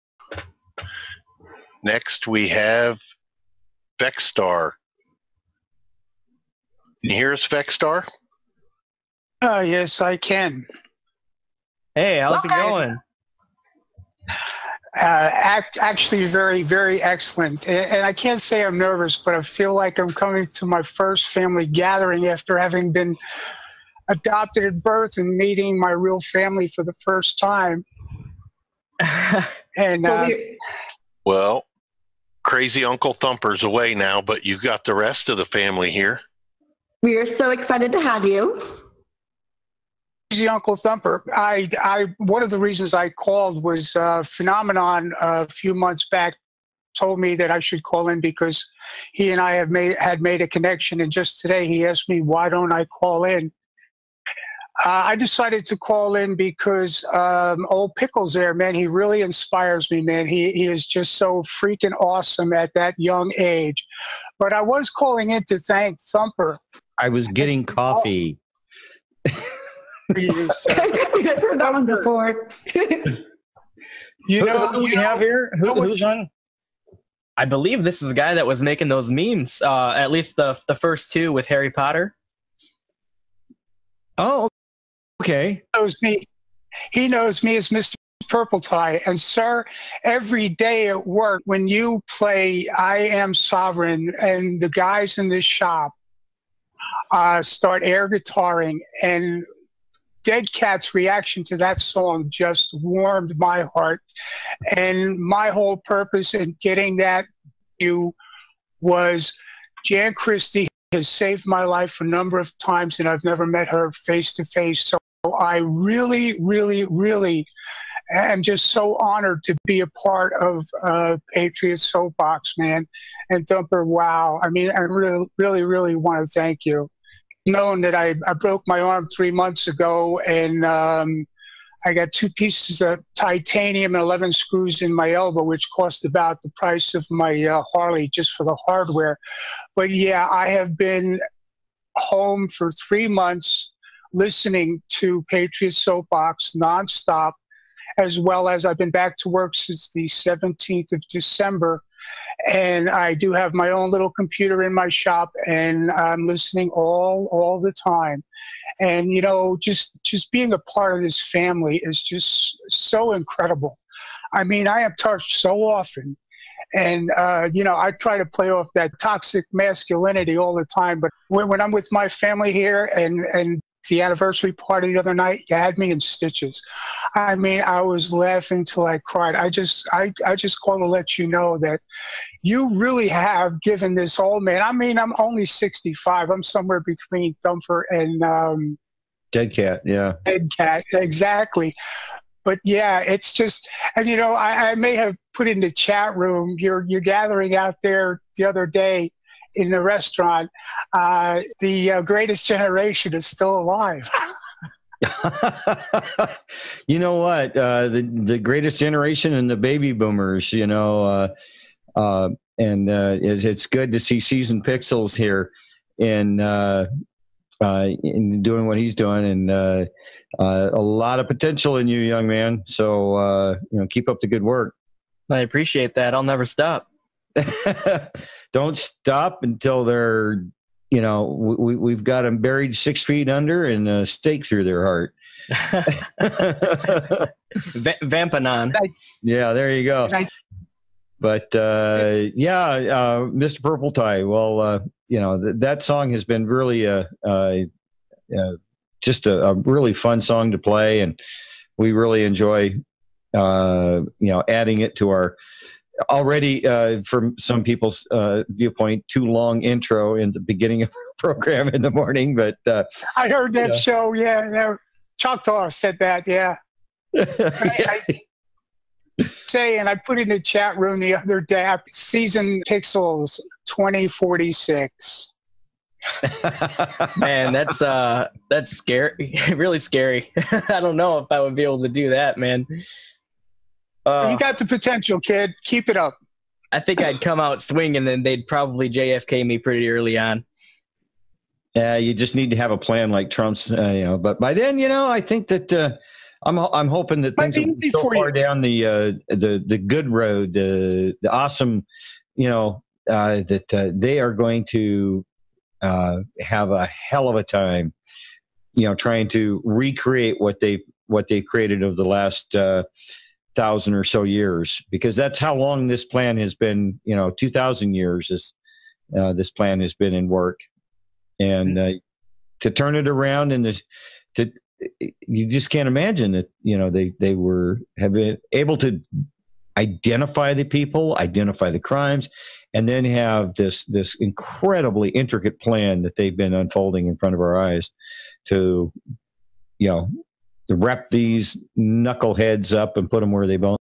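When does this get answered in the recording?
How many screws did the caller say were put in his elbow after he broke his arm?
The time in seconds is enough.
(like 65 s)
134 s.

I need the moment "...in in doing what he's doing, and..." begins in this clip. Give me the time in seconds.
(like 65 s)
215 s.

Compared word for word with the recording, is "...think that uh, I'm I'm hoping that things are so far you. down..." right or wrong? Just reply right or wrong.
right.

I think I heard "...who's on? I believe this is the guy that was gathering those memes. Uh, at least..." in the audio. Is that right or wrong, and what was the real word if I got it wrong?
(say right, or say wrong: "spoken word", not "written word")
wrong: "making", not "gathering".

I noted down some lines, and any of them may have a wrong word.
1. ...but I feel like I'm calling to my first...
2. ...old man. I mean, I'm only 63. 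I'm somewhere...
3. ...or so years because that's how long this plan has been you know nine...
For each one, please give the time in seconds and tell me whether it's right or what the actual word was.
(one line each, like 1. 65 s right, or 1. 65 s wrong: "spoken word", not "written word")
1. 19 s wrong: "coming", not "calling"
2. 184 s wrong: "65", not "63"
3. 313 s wrong: "two", not "nine".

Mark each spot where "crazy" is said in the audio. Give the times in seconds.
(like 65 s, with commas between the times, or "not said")
32 s, 40 s.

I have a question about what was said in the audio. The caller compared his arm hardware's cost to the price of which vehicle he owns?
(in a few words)
Harley.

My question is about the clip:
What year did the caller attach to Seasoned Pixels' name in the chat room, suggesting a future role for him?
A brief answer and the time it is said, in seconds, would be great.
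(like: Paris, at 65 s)
2046, at 273 s.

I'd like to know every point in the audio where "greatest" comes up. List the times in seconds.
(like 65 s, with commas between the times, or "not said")
202 s, 208 s.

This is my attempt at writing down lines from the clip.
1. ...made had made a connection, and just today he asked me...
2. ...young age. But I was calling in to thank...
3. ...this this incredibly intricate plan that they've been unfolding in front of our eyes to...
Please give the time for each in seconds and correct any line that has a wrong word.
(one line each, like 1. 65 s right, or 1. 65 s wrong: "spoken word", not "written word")
1. 49 s right
2. 62 s right
3. 333 s right.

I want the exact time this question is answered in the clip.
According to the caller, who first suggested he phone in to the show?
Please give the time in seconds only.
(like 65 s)
44 s.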